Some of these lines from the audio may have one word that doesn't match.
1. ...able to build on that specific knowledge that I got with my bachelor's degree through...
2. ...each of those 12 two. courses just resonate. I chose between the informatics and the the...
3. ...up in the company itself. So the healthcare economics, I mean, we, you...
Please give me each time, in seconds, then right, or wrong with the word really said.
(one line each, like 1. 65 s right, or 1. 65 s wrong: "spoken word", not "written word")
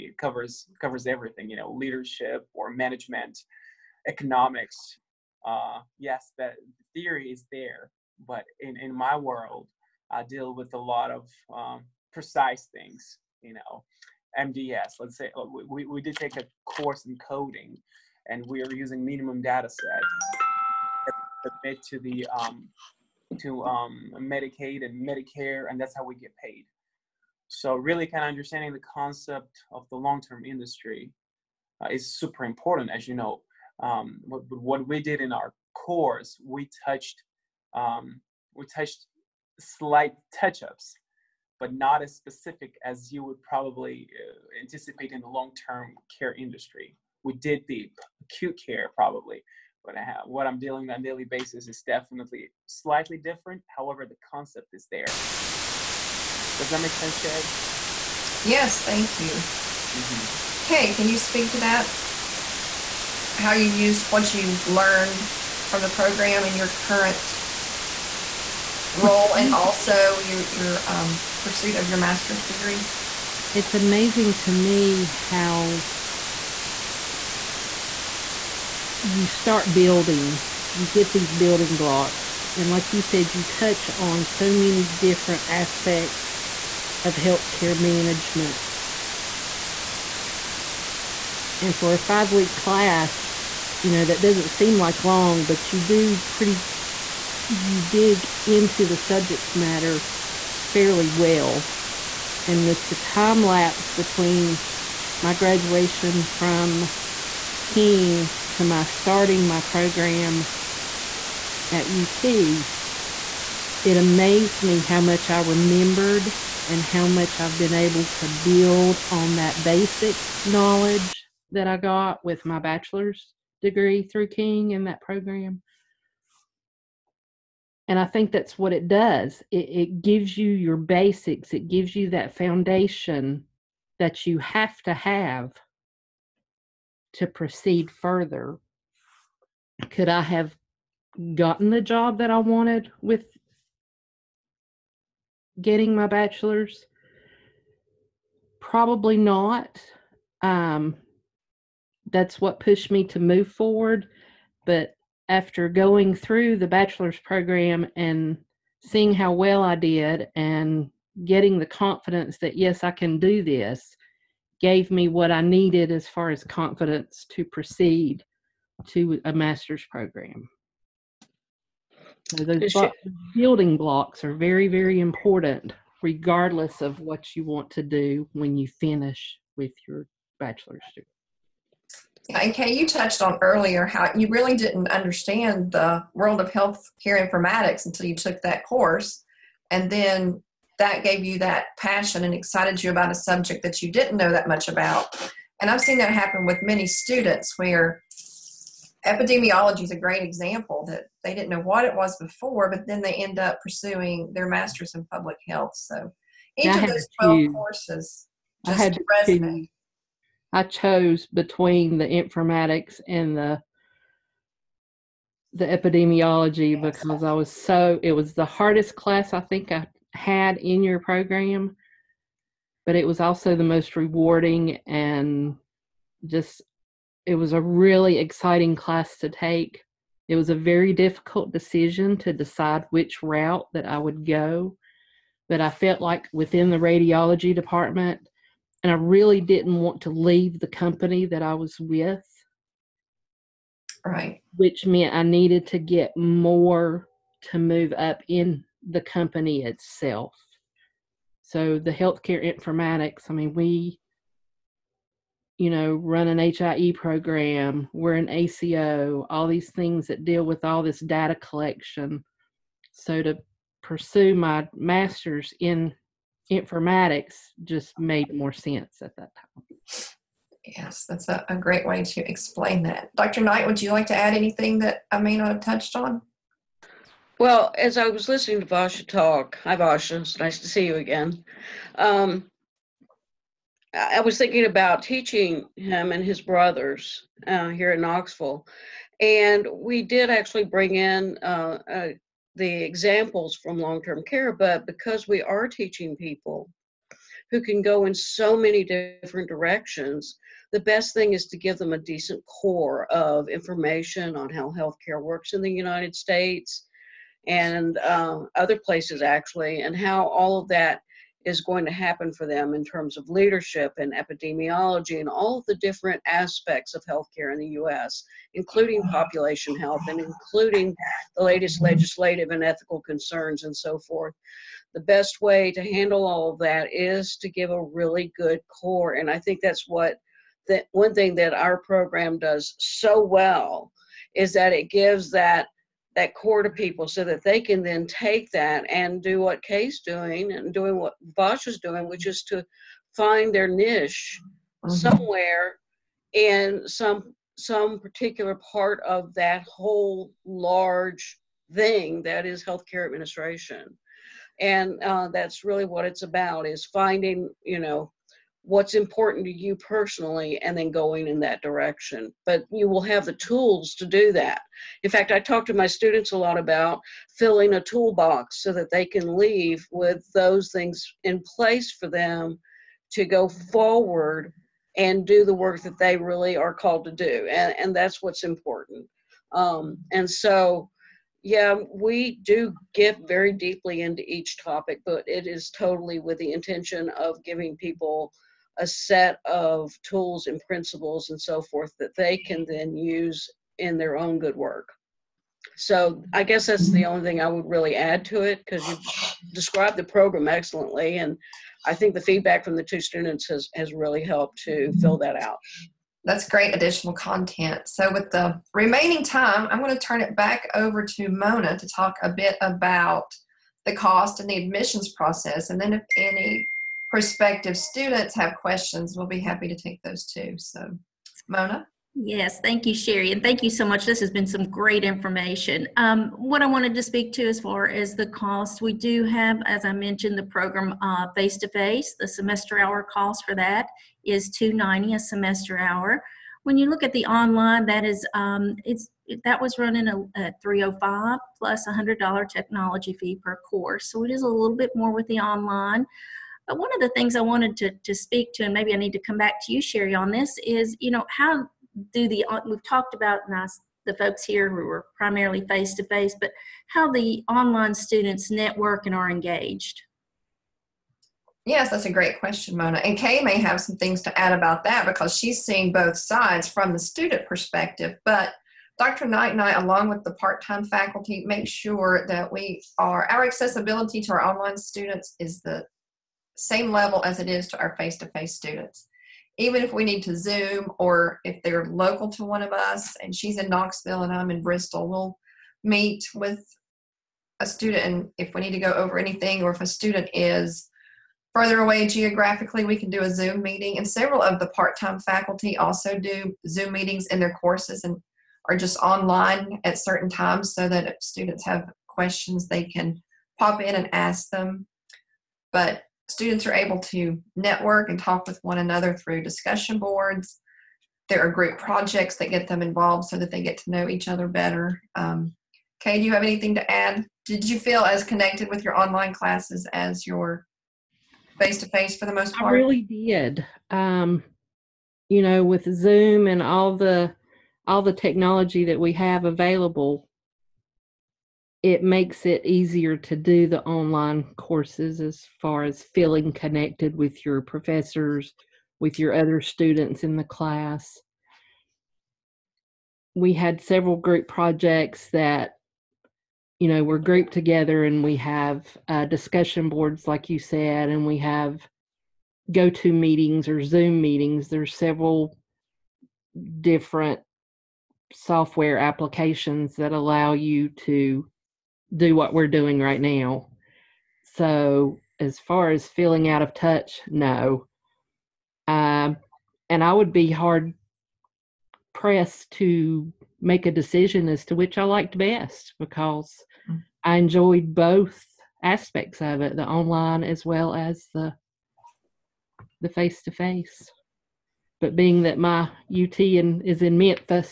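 1. 117 s wrong: "basic", not "specific"
2. 206 s right
3. 247 s wrong: "informatics", not "economics".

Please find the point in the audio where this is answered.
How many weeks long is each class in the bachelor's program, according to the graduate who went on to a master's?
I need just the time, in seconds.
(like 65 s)
91 s.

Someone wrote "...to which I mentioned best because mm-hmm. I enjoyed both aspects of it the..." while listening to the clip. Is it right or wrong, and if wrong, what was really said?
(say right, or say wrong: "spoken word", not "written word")
wrong: "liked", not "mentioned".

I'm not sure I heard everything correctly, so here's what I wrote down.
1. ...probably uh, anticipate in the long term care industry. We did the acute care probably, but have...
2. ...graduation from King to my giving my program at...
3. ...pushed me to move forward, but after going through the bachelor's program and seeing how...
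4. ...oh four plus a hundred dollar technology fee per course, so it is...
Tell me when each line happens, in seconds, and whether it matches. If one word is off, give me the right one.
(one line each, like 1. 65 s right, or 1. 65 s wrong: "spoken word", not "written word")
1. 43 s right
2. 105 s wrong: "starting", not "giving"
3. 152 s right
4. 440 s wrong: "five", not "four".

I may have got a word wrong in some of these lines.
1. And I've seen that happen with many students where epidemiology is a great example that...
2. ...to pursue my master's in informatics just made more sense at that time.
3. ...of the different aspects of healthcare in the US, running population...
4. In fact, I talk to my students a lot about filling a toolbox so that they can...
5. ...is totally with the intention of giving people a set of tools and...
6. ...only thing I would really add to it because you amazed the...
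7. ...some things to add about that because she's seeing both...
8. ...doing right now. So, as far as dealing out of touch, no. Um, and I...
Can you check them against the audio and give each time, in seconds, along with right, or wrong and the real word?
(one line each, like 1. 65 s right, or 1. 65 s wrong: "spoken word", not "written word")
1. 195 s right
2. 263 s right
3. 315 s wrong: "including", not "running"
4. 365 s right
5. 385 s right
6. 397 s wrong: "described", not "amazed"
7. 463 s right
8. 562 s wrong: "feeling", not "dealing".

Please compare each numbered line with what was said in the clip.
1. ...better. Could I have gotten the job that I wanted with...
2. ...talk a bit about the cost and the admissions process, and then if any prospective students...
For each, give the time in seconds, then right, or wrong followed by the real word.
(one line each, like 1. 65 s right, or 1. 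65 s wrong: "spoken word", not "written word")
1. 137 s wrong: "further", not "better"
2. 411 s right.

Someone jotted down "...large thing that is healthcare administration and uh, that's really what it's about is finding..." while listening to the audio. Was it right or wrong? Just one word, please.
right.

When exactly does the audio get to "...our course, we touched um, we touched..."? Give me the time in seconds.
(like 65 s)
35 s.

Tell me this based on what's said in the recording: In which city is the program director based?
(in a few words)
Bristol.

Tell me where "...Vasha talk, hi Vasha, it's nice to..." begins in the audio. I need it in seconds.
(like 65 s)
278 s.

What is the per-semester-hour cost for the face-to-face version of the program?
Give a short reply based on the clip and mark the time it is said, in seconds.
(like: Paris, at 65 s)
$290, at 434 s.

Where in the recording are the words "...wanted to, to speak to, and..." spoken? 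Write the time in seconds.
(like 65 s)
447 s.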